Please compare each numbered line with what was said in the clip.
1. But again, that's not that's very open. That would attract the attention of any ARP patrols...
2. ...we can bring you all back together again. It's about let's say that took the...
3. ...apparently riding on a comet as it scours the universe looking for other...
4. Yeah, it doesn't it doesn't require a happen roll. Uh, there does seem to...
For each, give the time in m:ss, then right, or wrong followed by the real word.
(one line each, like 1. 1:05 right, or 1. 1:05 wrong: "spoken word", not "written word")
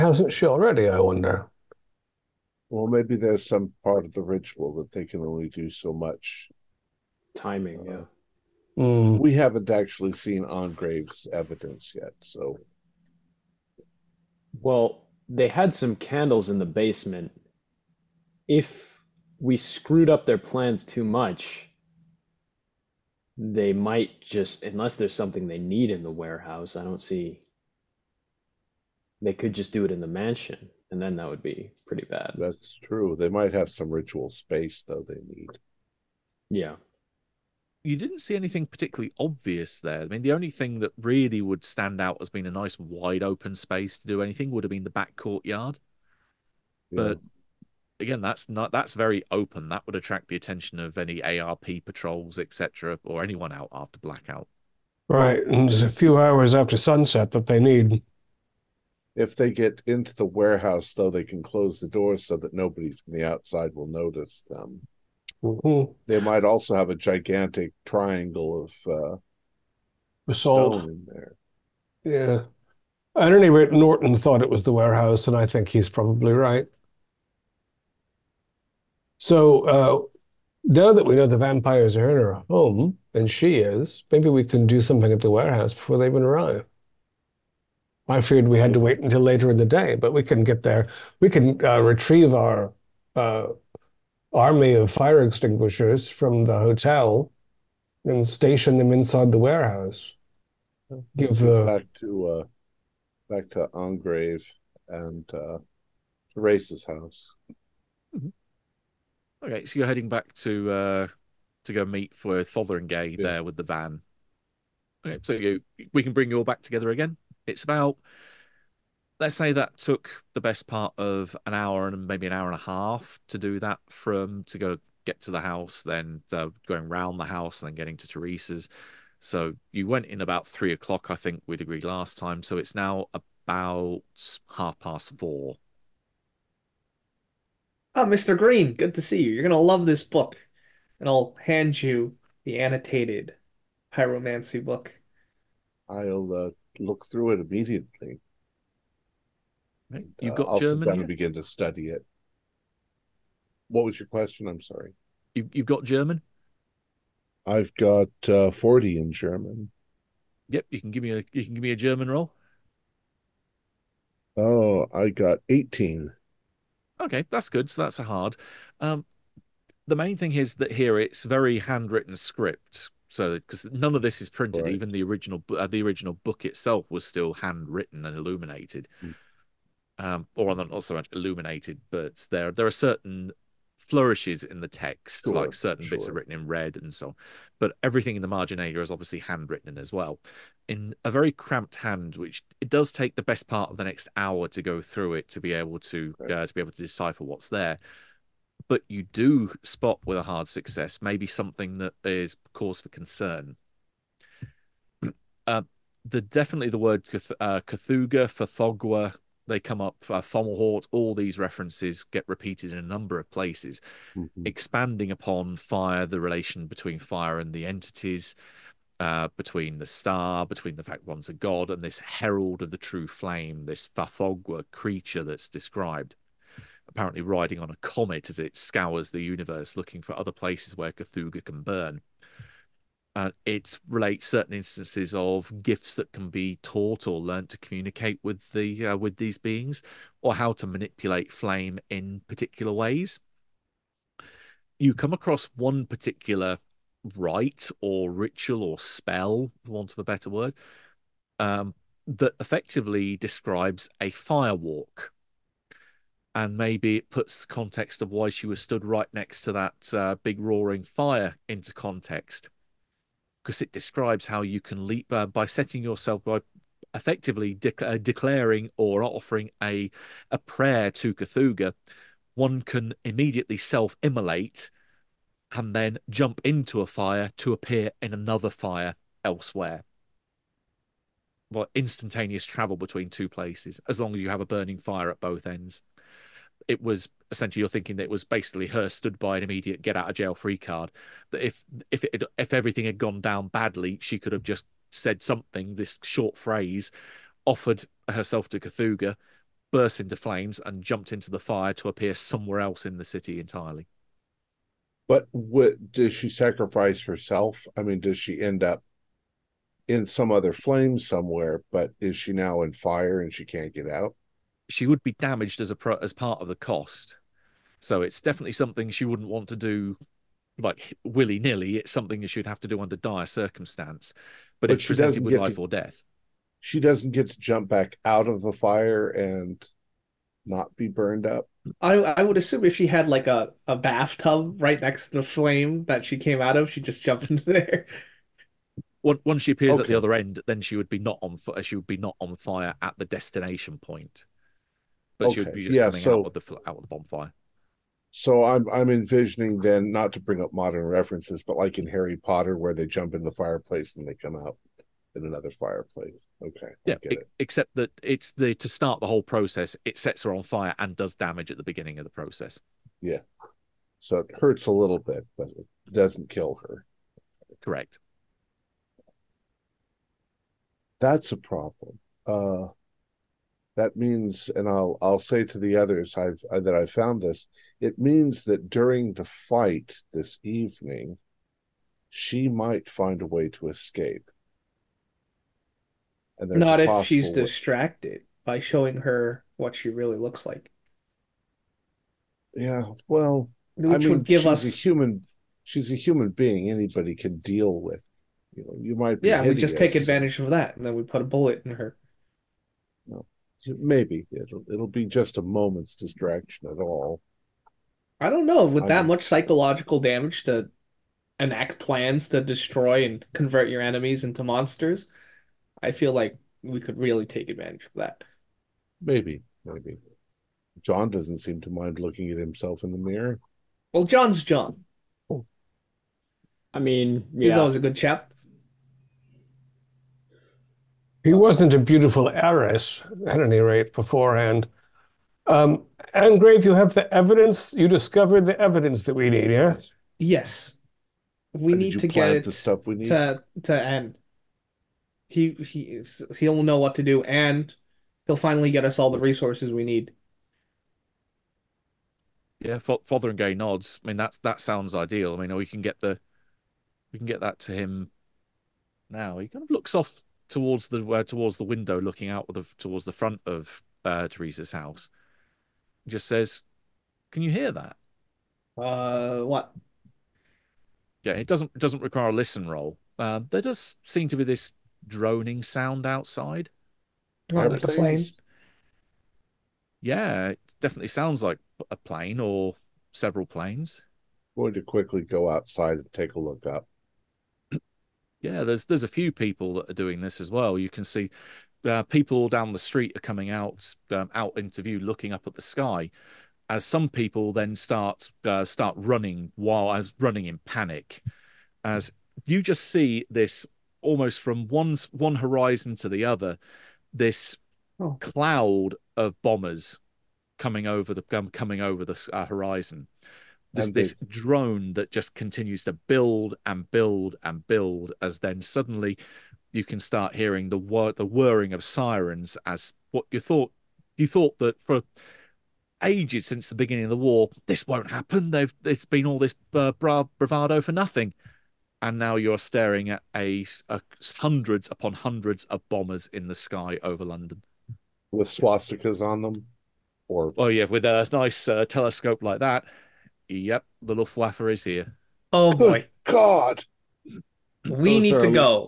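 1. 0:47 right
2. 1:55 right
3. 3:46 right
4. 7:51 wrong: "listen", not "happen".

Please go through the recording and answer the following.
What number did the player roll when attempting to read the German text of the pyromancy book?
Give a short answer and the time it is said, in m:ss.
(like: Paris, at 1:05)
18, at 2:45.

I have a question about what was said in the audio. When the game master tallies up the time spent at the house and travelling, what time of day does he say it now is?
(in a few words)
half past four.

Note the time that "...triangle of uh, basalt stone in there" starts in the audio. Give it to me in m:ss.
1:07.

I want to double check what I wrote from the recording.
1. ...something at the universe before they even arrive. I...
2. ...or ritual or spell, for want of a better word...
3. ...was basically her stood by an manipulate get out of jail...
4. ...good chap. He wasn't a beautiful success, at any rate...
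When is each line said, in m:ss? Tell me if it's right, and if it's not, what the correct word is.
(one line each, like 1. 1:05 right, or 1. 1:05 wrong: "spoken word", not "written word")
1. 1:24 wrong: "warehouse", not "universe"
2. 4:07 right
3. 4:48 wrong: "immediate", not "manipulate"
4. 7:07 wrong: "heiress", not "success".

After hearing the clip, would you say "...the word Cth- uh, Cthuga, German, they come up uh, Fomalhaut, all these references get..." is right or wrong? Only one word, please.
wrong.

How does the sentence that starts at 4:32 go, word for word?
One can immediately self-immolate and then jump into a fire to appear in another fire elsewhere.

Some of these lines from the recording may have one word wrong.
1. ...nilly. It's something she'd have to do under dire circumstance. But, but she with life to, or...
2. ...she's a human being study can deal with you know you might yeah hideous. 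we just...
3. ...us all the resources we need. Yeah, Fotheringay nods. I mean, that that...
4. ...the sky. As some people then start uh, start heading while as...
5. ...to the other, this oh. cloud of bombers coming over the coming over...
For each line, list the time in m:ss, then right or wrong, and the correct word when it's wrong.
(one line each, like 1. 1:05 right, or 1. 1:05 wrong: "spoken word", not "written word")
1. 5:21 right
2. 6:35 wrong: "anybody", not "study"
3. 7:28 right
4. 8:15 wrong: "running", not "heading"
5. 8:25 right.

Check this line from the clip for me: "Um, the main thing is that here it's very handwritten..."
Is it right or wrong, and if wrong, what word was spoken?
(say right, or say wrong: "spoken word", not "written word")
right.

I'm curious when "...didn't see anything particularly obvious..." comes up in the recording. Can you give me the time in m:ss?
0:37.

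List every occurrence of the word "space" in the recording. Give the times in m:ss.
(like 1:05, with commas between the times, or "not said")
0:34, 0:43.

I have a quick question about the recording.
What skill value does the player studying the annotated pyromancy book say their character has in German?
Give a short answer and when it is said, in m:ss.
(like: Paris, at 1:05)
40, at 2:38.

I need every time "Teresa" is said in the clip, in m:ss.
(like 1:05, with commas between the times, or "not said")
2:08, 7:44.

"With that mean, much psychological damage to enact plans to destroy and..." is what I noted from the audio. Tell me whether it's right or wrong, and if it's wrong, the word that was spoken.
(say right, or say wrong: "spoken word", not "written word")
right.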